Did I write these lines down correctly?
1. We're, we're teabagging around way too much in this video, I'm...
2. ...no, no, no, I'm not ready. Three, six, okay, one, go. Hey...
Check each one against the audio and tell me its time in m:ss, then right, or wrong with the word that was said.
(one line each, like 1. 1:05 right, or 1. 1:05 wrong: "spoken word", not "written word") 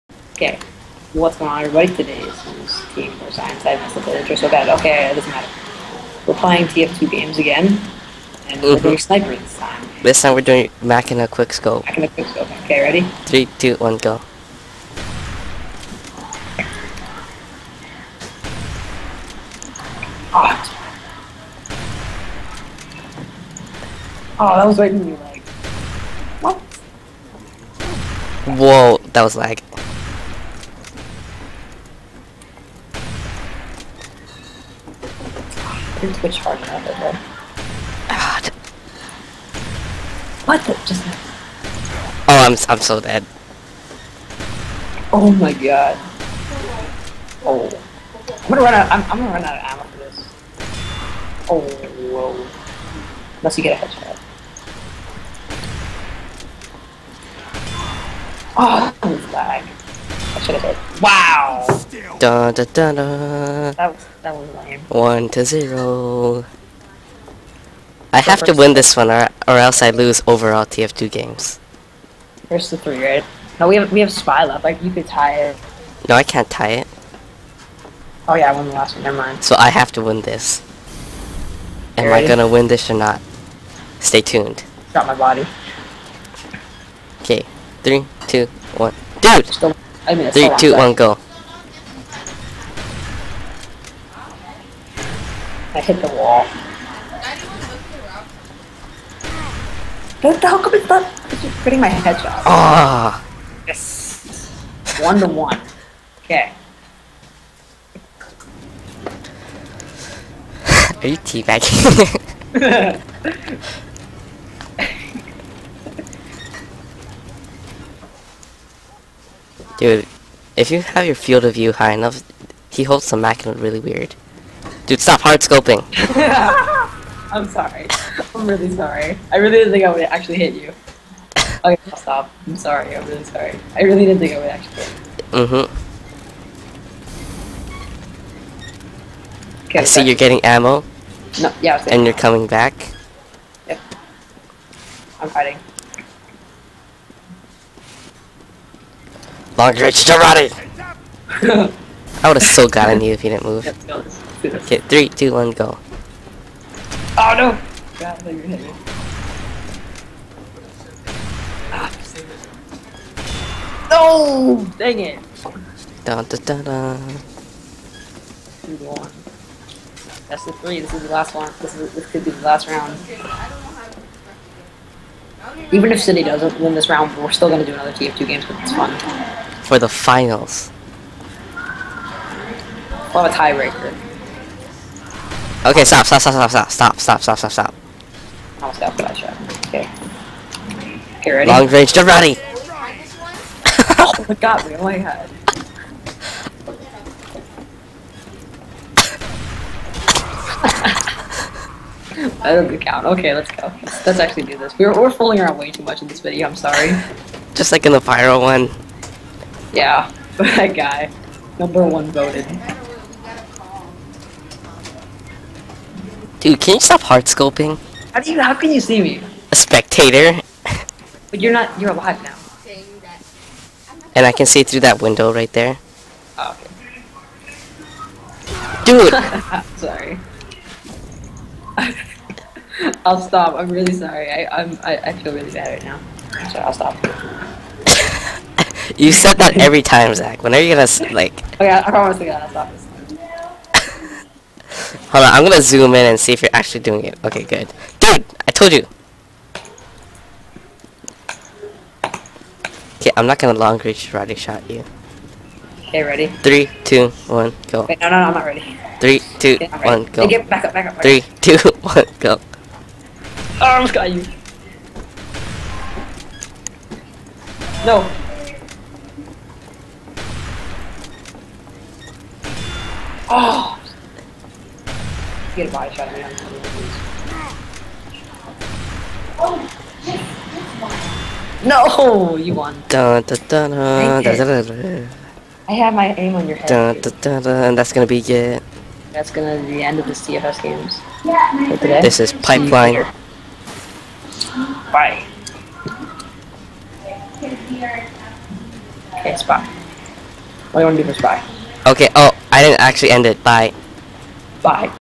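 1. 3:24 wrong: "fooling", not "teabagging"
2. 4:17 wrong: "two", not "six".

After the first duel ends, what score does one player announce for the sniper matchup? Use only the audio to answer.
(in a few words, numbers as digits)
1 to 0.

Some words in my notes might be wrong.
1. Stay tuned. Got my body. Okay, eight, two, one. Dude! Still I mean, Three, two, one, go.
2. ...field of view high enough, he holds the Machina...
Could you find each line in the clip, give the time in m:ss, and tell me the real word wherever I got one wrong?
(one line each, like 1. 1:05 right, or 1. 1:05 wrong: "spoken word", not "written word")
1. 1:23 wrong: "three", not "eight"
2. 2:01 right.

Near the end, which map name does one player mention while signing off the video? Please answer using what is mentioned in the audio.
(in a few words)
Pipeline.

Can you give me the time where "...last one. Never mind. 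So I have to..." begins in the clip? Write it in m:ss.
1:18.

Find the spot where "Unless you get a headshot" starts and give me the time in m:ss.
0:53.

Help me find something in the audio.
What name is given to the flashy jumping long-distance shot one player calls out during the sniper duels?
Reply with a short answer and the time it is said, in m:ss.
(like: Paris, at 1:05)
Long reach Roddy, at 2:29.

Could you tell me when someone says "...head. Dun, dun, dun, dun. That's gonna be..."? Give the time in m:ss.
4:46.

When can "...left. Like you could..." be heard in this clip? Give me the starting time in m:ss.
1:14.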